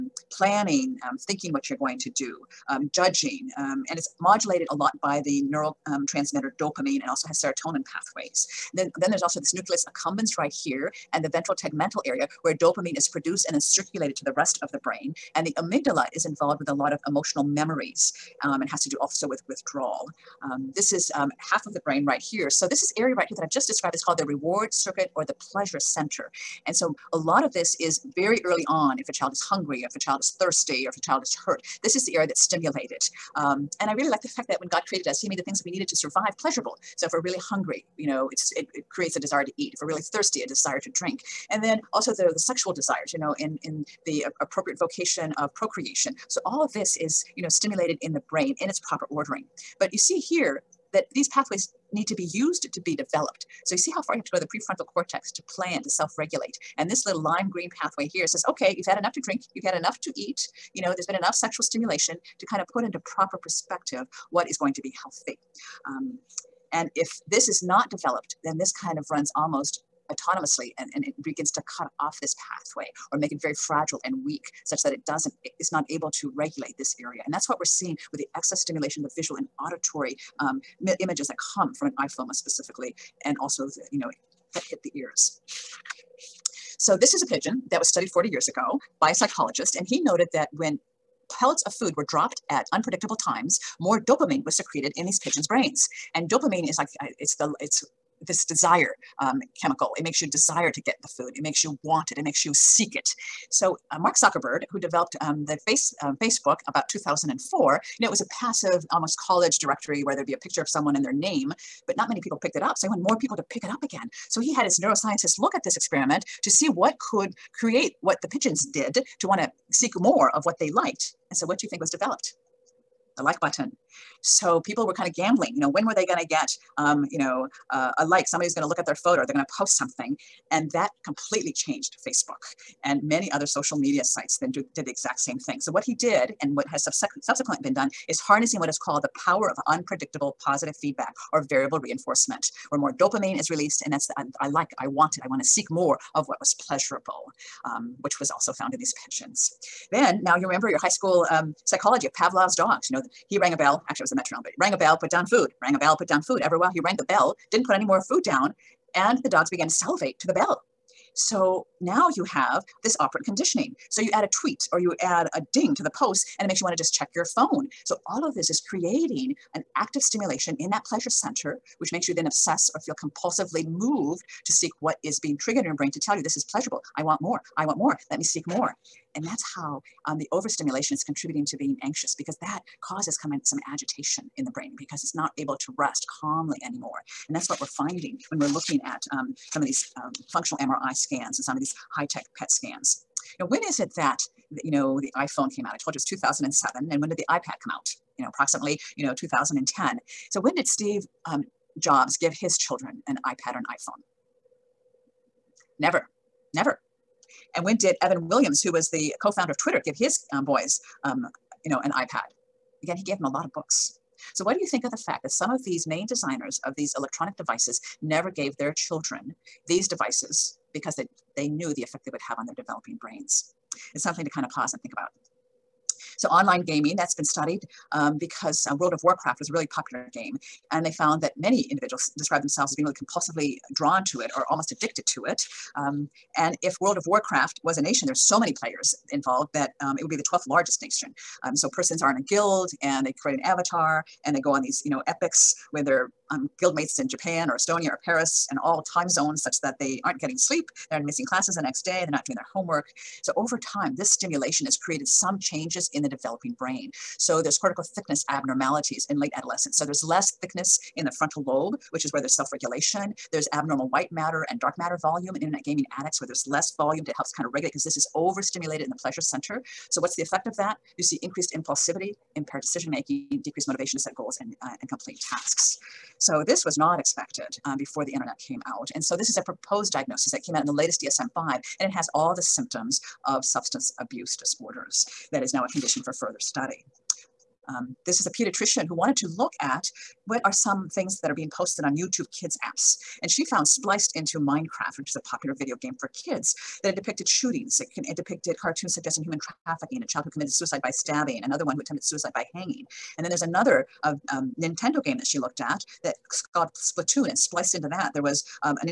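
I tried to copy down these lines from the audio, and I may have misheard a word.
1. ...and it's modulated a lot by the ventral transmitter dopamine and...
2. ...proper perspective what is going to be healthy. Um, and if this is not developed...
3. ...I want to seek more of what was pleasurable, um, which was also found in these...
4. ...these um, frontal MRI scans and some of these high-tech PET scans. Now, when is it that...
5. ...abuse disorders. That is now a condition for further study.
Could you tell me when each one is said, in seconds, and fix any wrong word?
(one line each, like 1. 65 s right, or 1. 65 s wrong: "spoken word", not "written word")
1. 3 s wrong: "neural", not "ventral"
2. 63 s right
3. 145 s right
4. 189 s wrong: "functional", not "frontal"
5. 283 s right.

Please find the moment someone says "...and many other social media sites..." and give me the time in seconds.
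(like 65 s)
132 s.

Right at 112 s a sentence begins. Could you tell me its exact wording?
So he wanted more people to pick it up again.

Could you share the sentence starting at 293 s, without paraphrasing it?
And she found spliced into Minecraft, which is a popular video game for kids, that it depicted shootings.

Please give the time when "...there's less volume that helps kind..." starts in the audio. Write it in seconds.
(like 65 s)
266 s.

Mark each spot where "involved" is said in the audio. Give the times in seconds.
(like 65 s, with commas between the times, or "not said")
16 s, 239 s.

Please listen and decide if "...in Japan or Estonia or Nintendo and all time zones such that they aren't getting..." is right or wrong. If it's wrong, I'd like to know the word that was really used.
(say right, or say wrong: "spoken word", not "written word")
wrong: "Paris", not "Nintendo".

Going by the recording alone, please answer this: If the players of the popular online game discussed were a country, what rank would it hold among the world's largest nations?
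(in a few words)
12th.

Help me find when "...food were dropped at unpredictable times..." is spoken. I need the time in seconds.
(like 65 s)
91 s.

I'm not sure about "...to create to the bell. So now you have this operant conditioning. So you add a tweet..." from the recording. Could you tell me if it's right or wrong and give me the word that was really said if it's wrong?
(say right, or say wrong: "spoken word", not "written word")
wrong: "salivate", not "create".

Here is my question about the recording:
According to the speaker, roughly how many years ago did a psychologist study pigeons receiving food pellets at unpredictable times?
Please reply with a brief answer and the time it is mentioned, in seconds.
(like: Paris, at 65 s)
40 years, at 88 s.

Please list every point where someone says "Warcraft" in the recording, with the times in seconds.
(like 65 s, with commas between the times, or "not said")
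229 s, 237 s.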